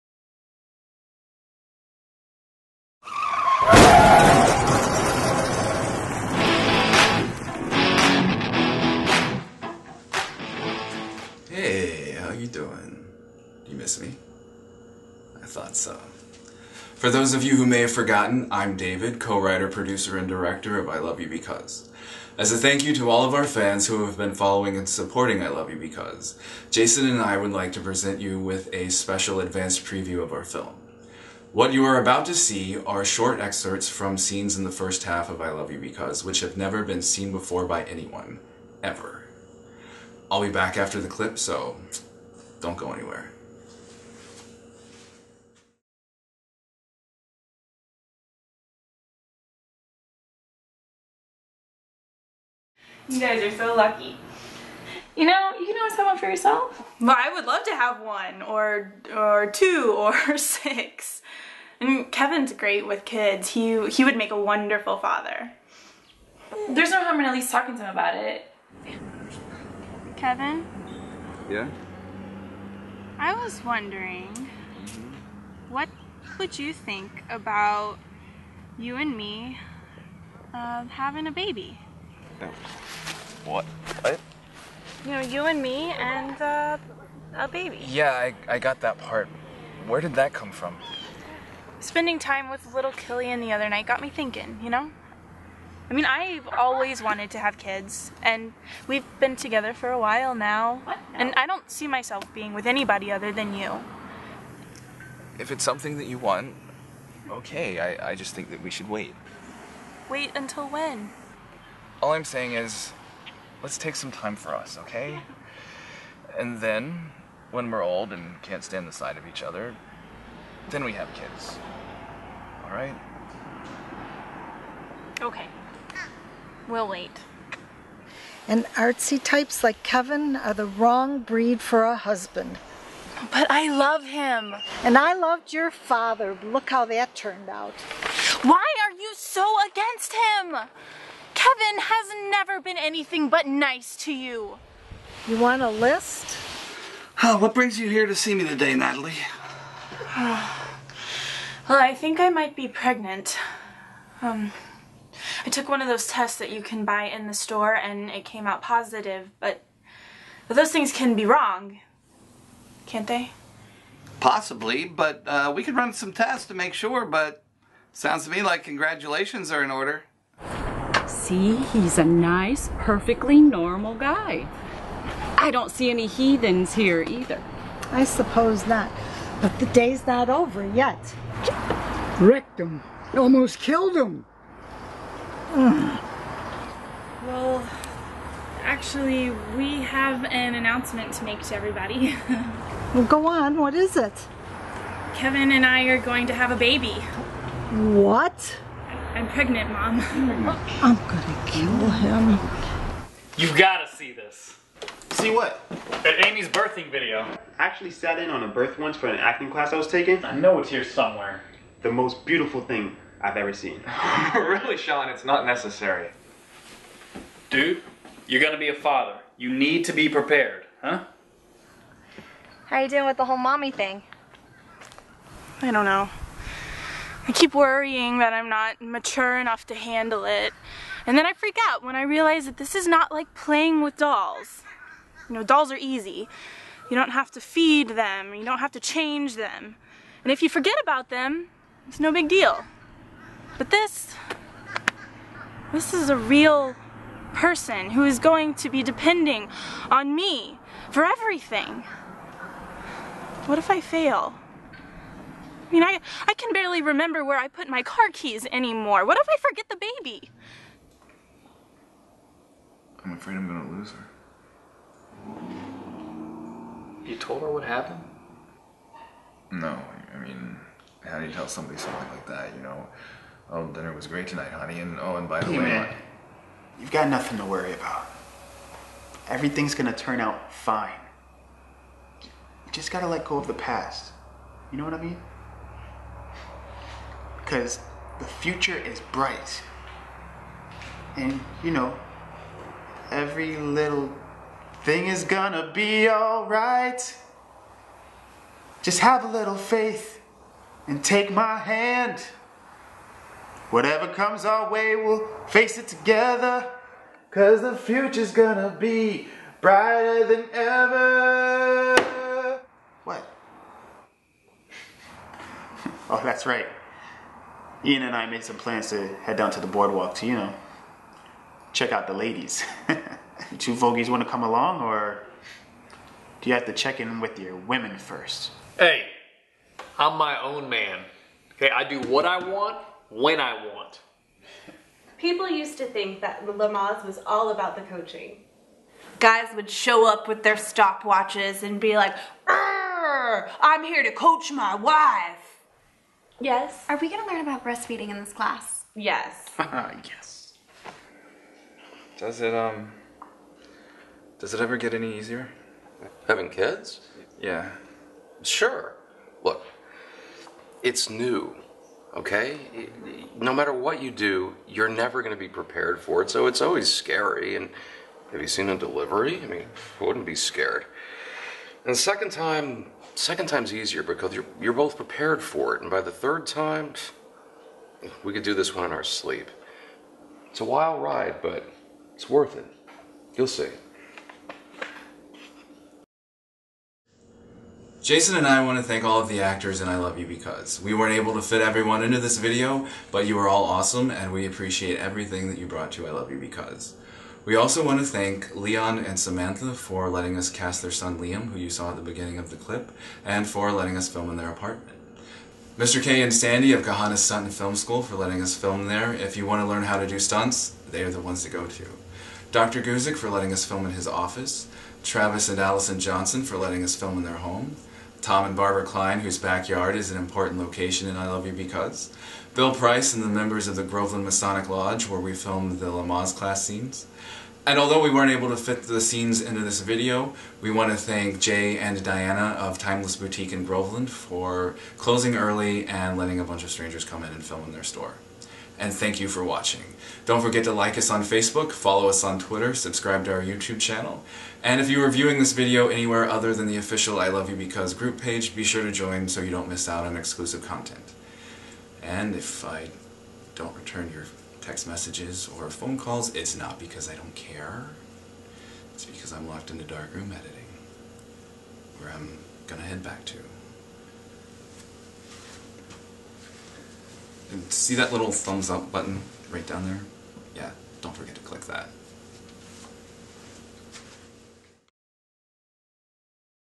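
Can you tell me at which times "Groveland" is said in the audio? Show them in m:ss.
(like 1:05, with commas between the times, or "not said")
7:03, 7:13.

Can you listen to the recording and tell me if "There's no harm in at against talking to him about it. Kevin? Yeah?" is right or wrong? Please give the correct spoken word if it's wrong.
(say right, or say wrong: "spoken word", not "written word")
wrong: "least", not "against".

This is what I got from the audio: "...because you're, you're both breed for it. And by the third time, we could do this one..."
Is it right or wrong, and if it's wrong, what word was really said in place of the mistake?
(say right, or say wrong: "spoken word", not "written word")
wrong: "prepared", not "breed".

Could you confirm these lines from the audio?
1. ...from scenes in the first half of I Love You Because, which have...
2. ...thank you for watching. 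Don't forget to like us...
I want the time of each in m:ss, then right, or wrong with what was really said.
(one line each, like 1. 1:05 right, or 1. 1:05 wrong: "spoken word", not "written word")
1. 0:33 right
2. 7:18 right.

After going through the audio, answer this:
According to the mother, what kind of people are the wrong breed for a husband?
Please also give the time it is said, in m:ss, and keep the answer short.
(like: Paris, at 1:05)
Artsy types, at 2:08.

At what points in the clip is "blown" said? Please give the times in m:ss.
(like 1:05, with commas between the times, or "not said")
not said.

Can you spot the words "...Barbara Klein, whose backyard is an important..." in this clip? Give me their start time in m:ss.
6:58.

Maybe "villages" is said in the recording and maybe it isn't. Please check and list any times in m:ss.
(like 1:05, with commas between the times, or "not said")
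not said.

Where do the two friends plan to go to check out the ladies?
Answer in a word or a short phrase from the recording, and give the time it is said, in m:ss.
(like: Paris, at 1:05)
The boardwalk, at 5:19.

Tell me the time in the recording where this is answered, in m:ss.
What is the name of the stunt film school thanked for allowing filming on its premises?
6:46.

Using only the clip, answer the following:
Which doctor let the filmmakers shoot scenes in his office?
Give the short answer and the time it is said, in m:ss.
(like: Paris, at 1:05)
Dr. Guzik, at 6:52.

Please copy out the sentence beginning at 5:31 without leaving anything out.
Okay, I do what I want when I want.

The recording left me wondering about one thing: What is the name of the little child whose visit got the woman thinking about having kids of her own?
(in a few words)
Killian.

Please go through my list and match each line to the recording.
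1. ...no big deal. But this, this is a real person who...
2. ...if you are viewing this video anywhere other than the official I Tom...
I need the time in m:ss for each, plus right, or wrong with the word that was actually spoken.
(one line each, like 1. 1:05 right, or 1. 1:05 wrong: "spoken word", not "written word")
1. 4:01 right
2. 7:24 wrong: "Love", not "Tom".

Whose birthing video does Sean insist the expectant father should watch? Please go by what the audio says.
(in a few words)
Amy's.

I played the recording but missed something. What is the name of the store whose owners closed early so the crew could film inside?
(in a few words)
Timeless Boutique.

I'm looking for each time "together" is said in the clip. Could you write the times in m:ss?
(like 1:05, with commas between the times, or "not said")
1:39, 5:05.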